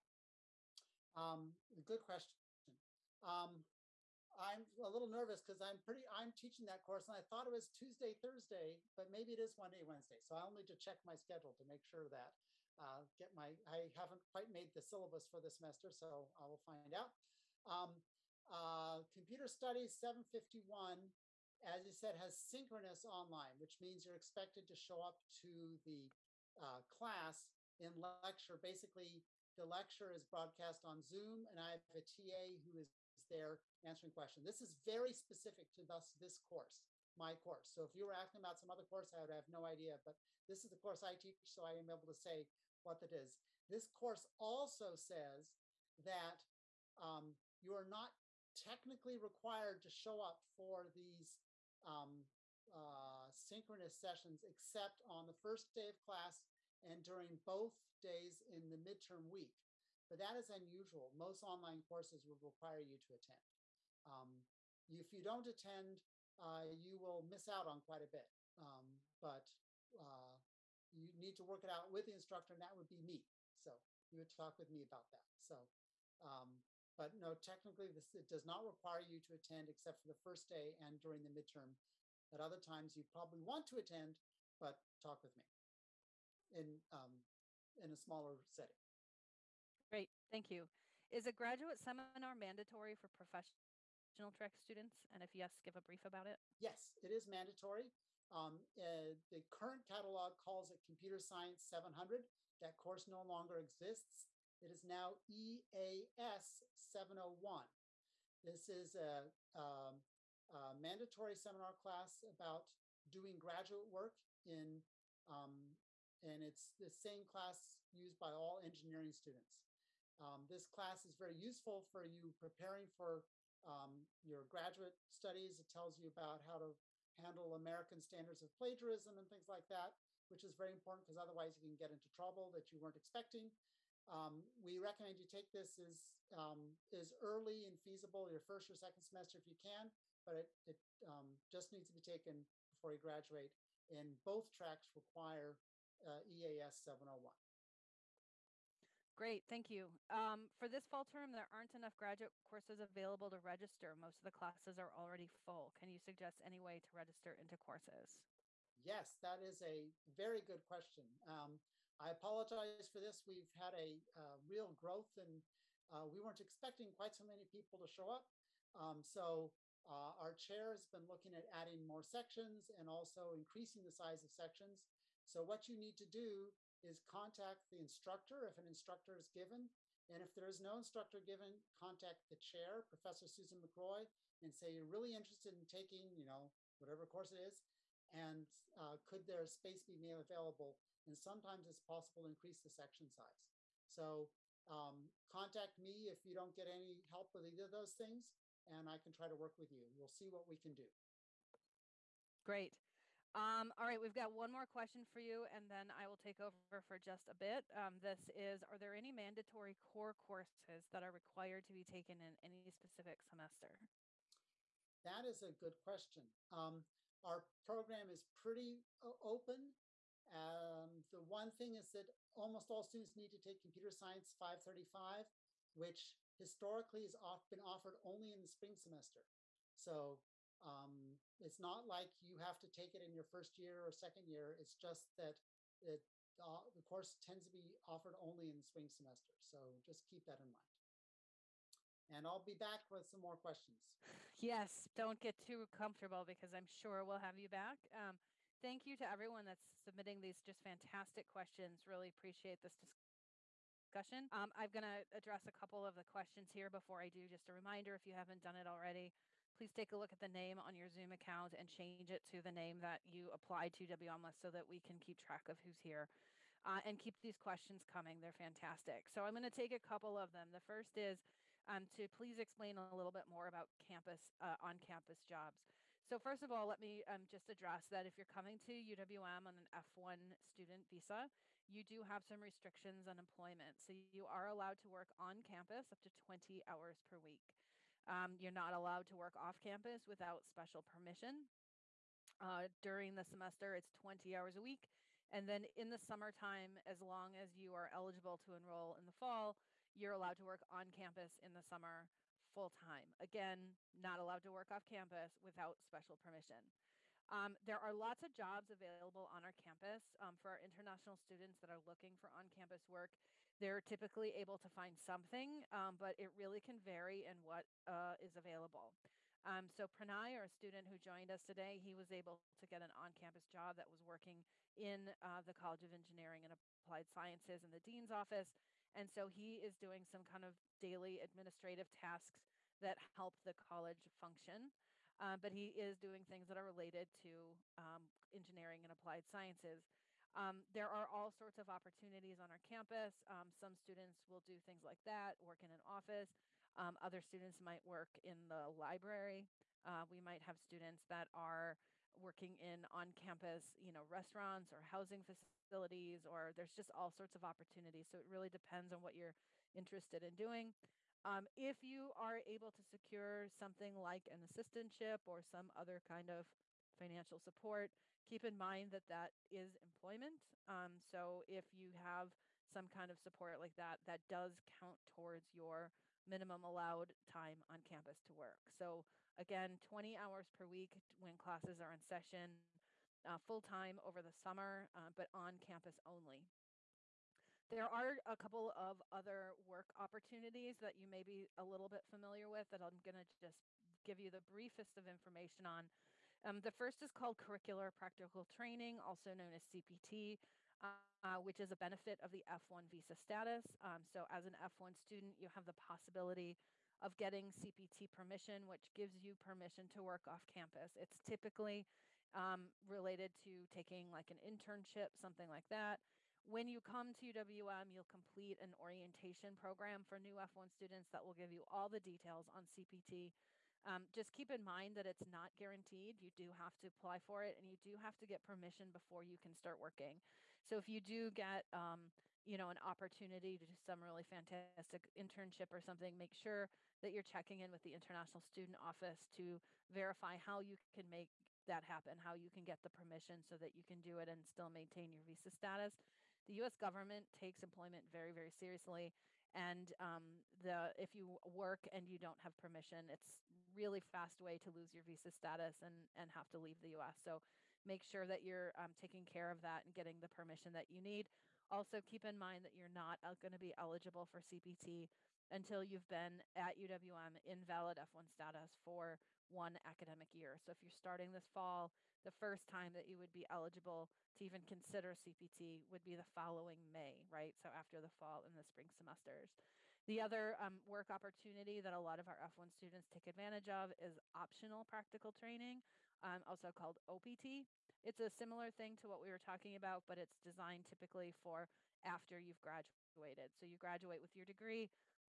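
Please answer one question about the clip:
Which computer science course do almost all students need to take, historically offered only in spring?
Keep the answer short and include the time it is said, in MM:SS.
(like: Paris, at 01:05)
Computer Science 535, at 03:43.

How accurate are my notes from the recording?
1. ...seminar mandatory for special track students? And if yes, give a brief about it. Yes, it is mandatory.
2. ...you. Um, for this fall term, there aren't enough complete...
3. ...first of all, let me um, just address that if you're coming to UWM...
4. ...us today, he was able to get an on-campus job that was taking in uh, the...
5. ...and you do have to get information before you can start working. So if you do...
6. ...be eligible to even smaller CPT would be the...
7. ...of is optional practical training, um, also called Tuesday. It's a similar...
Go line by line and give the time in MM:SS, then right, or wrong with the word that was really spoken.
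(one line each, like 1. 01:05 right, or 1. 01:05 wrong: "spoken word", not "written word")
1. 01:31 wrong: "professional", not "special"
2. 02:29 wrong: "graduate", not "complete"
3. 04:36 right
4. 05:21 wrong: "working", not "taking"
5. 07:07 wrong: "permission", not "information"
6. 07:53 wrong: "consider", not "smaller"
7. 08:03 wrong: "OPT", not "Tuesday".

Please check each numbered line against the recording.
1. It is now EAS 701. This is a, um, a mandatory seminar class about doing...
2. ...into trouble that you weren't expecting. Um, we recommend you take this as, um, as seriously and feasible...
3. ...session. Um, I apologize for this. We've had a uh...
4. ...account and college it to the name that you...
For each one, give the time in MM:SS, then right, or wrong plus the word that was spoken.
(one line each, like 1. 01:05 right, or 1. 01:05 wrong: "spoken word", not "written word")
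1. 01:44 right
2. 02:11 wrong: "early", not "seriously"
3. 02:40 wrong: "question", not "session"
4. 04:21 wrong: "change", not "college".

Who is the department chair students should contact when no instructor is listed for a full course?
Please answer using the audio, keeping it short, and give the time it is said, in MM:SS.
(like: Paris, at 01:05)
Susan McRoy, at 03:03.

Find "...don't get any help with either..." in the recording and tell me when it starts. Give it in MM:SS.
03:16.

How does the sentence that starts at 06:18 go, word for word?
So again, 20 hours per week when classes are in session, uh, full time over the summer, uh, but on campus only.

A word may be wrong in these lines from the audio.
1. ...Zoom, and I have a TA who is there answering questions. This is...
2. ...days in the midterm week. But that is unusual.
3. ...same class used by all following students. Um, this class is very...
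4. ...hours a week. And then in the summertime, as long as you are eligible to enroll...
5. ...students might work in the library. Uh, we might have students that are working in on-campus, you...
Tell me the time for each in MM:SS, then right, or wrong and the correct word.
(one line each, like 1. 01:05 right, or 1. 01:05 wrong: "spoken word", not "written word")
1. 00:31 right
2. 00:57 right
3. 01:56 wrong: "engineering", not "following"
4. 04:54 right
5. 05:47 right.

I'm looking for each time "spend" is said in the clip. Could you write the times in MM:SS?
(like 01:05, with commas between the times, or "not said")
not said.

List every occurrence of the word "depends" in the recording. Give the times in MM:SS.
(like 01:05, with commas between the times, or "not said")
05:58.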